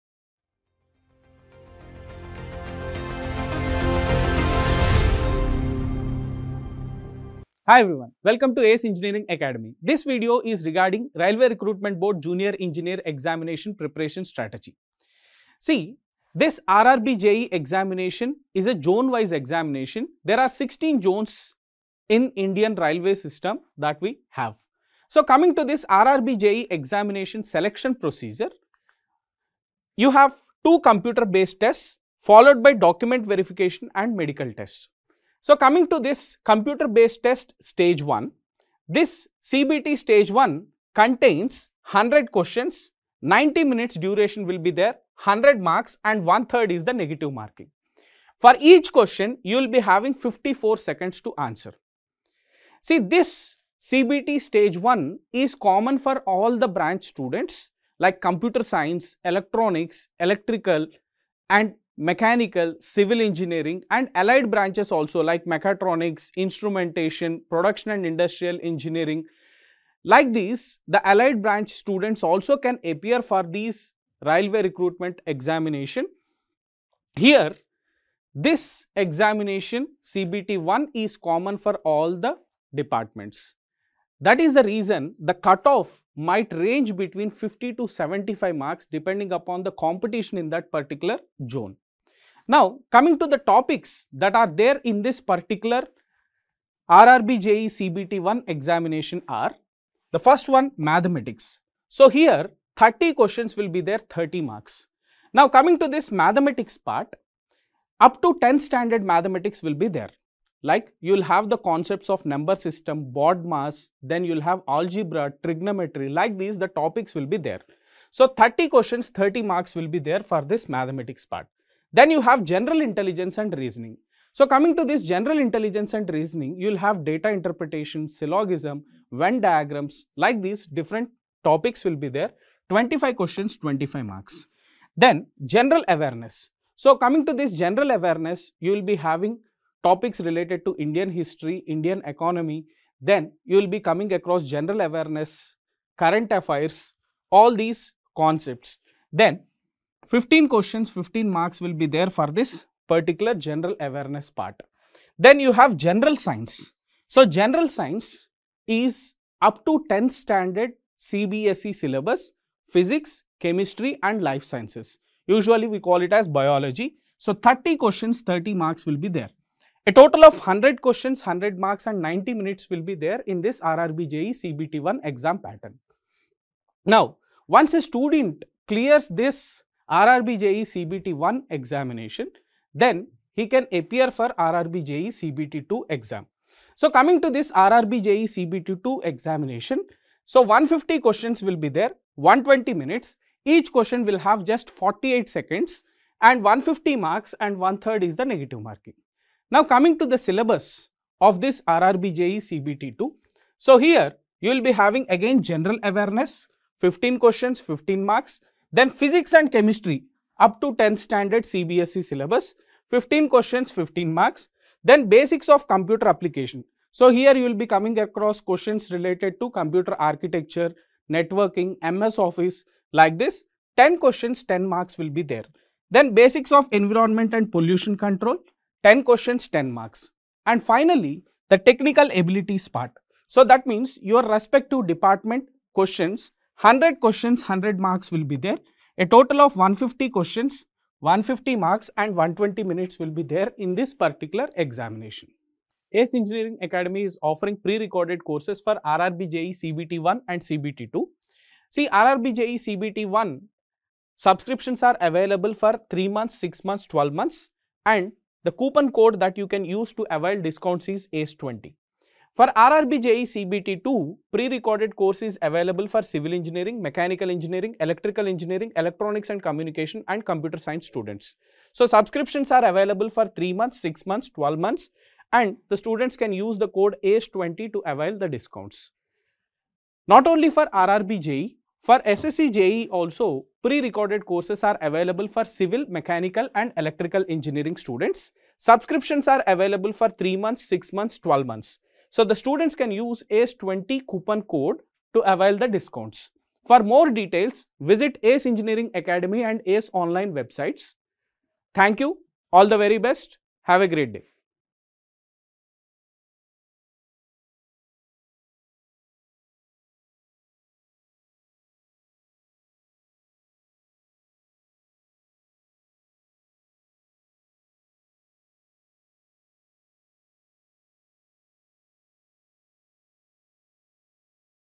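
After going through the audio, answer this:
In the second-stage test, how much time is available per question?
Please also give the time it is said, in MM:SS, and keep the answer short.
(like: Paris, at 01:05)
48 seconds, at 03:14.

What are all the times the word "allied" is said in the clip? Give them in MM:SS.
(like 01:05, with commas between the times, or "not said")
01:04, 01:11.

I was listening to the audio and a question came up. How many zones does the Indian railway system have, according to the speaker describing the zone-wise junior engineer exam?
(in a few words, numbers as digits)
16.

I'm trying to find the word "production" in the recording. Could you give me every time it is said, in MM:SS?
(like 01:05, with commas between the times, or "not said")
01:07.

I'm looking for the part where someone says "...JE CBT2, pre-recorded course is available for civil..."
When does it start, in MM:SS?
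04:23.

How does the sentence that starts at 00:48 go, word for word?
For each question, you will be having 54 seconds to answer.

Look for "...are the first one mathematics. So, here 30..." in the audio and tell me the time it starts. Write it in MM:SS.
01:39.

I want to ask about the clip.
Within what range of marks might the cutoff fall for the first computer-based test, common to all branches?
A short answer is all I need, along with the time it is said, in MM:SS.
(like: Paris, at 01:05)
50 to 75, at 01:27.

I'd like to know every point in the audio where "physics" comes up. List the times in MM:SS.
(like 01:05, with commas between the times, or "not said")
02:42, 03:28.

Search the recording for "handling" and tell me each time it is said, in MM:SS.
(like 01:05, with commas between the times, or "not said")
not said.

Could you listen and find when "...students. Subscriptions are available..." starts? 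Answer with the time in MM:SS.
04:47.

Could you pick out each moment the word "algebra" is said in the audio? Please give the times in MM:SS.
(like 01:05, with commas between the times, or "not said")
01:54.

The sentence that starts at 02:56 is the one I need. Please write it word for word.
Now, once a student clears this RRBJE CBT1 examination, then he can appear for RRBJE CBT2 exam.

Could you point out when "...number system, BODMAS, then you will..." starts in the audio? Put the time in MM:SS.
01:52.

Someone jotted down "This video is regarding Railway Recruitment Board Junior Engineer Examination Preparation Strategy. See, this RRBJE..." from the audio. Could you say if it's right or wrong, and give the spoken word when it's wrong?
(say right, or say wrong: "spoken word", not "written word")
right.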